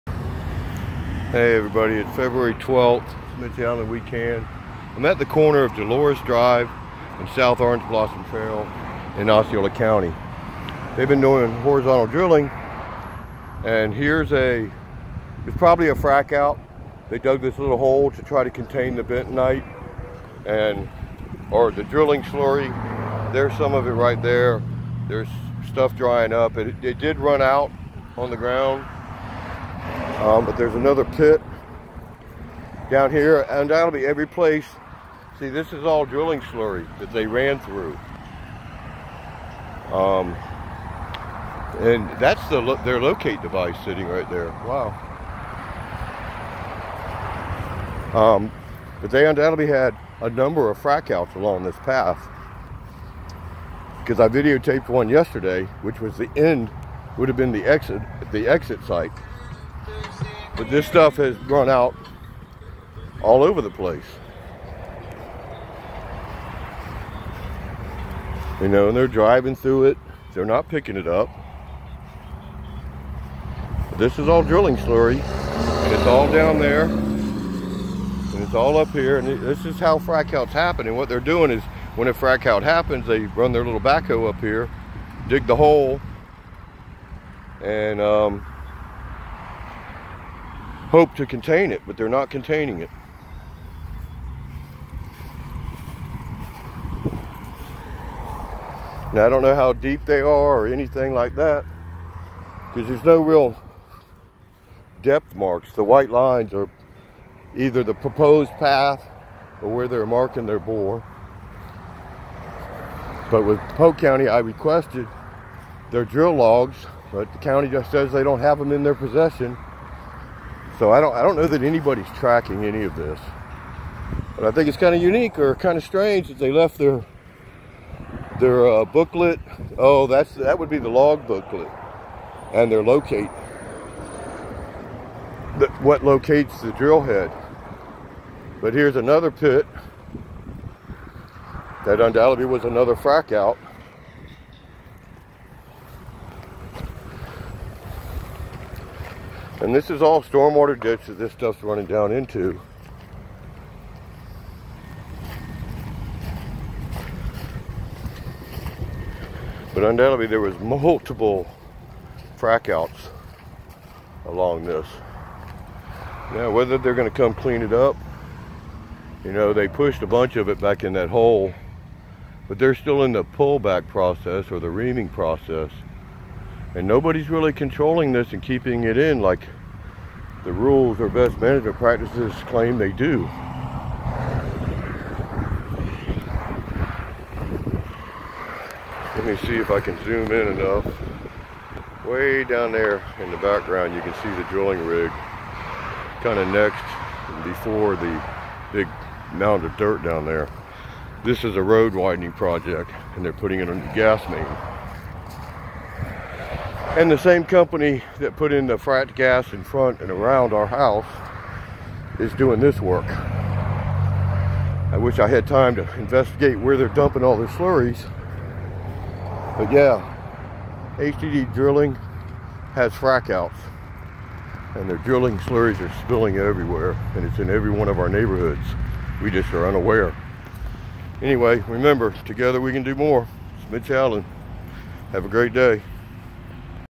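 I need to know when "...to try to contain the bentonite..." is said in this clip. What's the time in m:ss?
0:18.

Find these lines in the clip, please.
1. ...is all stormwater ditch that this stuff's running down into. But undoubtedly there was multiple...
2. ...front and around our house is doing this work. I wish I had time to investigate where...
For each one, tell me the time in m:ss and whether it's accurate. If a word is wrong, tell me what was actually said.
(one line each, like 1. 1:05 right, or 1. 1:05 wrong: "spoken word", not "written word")
1. 2:29 right
2. 3:29 right.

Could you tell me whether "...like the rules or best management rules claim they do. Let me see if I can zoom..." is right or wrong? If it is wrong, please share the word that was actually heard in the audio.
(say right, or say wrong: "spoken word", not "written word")
wrong: "practices", not "rules".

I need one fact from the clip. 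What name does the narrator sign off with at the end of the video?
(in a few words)
Mitch Allen.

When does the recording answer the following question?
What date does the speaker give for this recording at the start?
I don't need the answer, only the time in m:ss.
0:02.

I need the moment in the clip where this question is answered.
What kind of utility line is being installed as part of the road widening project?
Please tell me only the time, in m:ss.
3:23.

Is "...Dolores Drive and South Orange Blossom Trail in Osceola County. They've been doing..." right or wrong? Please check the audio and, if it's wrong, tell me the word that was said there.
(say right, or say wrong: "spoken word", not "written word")
right.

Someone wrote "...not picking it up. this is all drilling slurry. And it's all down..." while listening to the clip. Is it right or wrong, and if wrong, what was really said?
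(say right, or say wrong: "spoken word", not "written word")
right.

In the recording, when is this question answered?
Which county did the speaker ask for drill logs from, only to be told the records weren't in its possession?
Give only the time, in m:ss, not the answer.
1:53.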